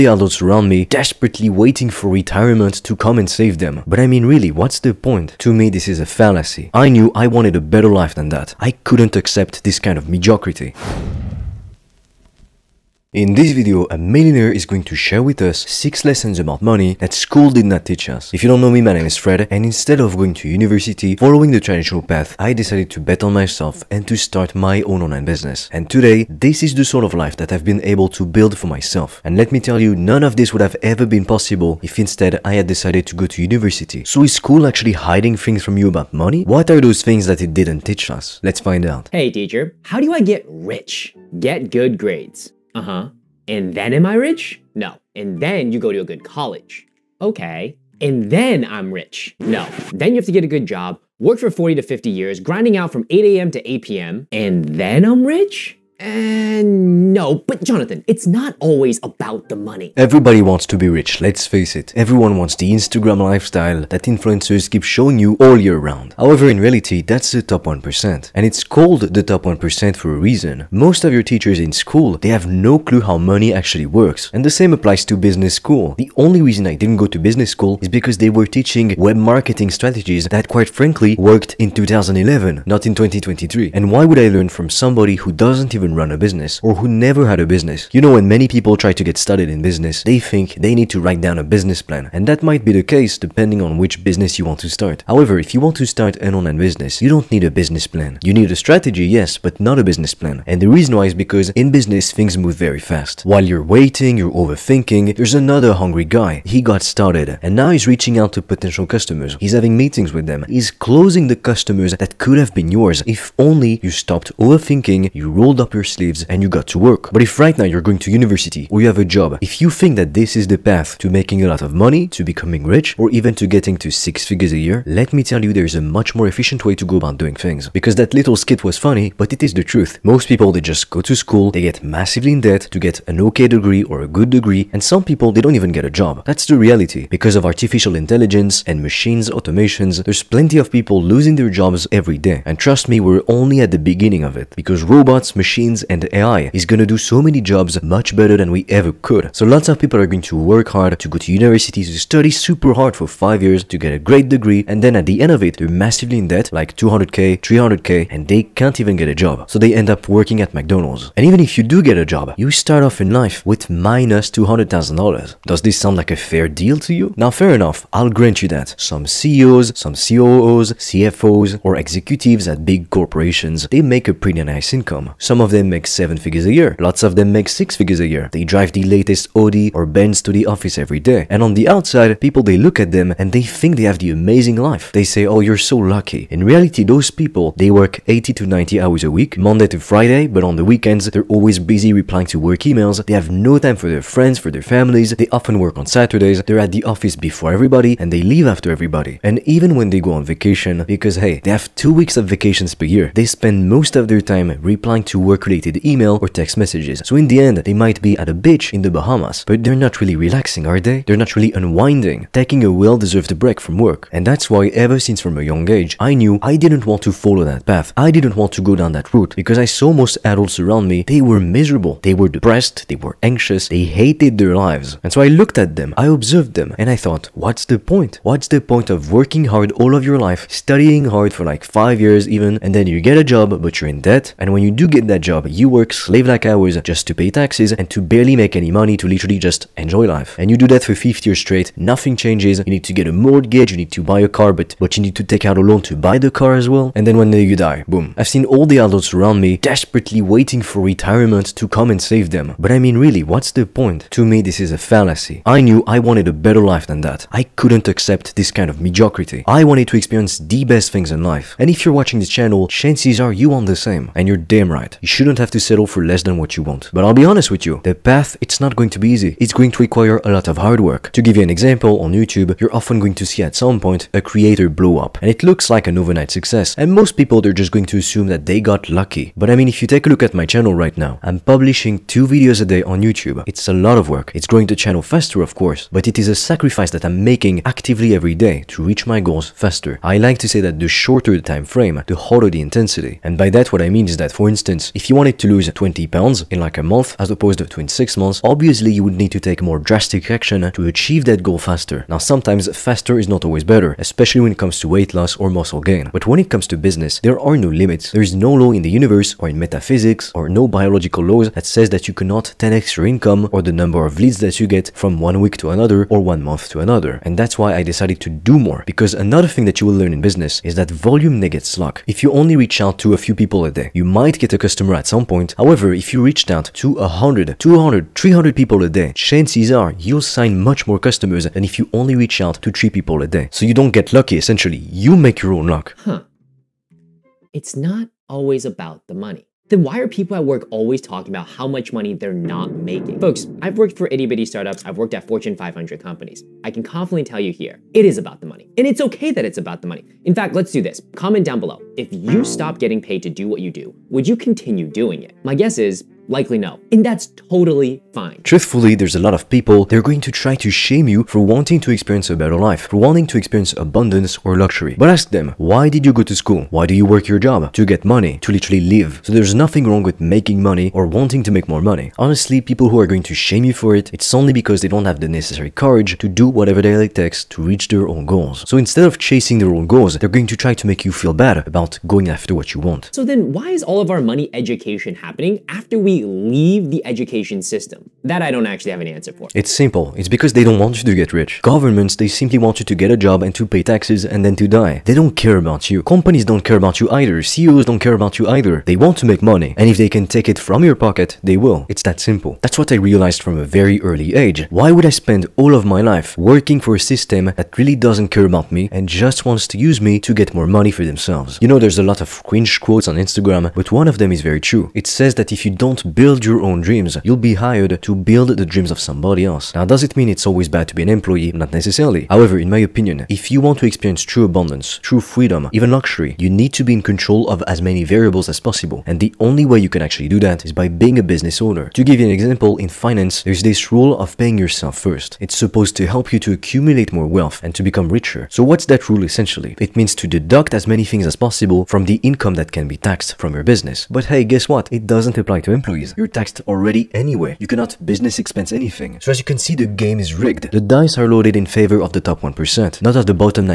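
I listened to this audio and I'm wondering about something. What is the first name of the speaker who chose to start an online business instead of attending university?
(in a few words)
Fred.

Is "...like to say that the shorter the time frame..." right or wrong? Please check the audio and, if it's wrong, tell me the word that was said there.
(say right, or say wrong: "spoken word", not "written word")
right.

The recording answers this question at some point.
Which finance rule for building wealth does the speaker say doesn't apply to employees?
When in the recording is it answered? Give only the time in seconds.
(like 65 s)
434 s.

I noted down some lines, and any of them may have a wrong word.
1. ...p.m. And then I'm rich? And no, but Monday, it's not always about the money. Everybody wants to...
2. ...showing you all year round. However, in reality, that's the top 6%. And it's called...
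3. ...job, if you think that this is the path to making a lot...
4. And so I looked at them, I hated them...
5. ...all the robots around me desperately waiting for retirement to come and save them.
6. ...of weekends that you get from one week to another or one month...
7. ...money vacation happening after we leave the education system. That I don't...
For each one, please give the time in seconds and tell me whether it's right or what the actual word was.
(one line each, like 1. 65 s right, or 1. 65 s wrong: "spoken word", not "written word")
1. 53 s wrong: "Jonathan", not "Monday"
2. 64 s wrong: "1", not "6"
3. 119 s right
4. 225 s wrong: "observed", not "hated"
5. 248 s wrong: "adults", not "robots"
6. 314 s wrong: "leads", not "weekends"
7. 384 s wrong: "education", not "vacation".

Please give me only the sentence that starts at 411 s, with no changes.
You know, there's a lot of cringe quotes on Instagram, but one of them is very true.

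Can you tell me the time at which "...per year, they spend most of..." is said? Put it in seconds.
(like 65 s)
202 s.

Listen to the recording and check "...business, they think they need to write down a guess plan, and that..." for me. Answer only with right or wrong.
wrong.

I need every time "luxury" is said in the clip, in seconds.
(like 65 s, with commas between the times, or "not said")
364 s, 425 s.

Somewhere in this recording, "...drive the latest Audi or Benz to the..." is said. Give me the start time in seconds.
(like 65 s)
178 s.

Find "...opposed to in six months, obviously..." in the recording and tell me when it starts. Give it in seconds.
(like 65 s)
297 s.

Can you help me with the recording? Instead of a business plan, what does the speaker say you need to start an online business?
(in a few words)
A strategy.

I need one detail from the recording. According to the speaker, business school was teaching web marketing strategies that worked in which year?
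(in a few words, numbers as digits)
2011.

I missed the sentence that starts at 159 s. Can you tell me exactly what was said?
So they end up working at McDonald's.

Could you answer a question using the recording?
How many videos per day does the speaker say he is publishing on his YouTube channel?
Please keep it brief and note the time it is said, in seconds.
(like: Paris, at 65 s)
2, at 282 s.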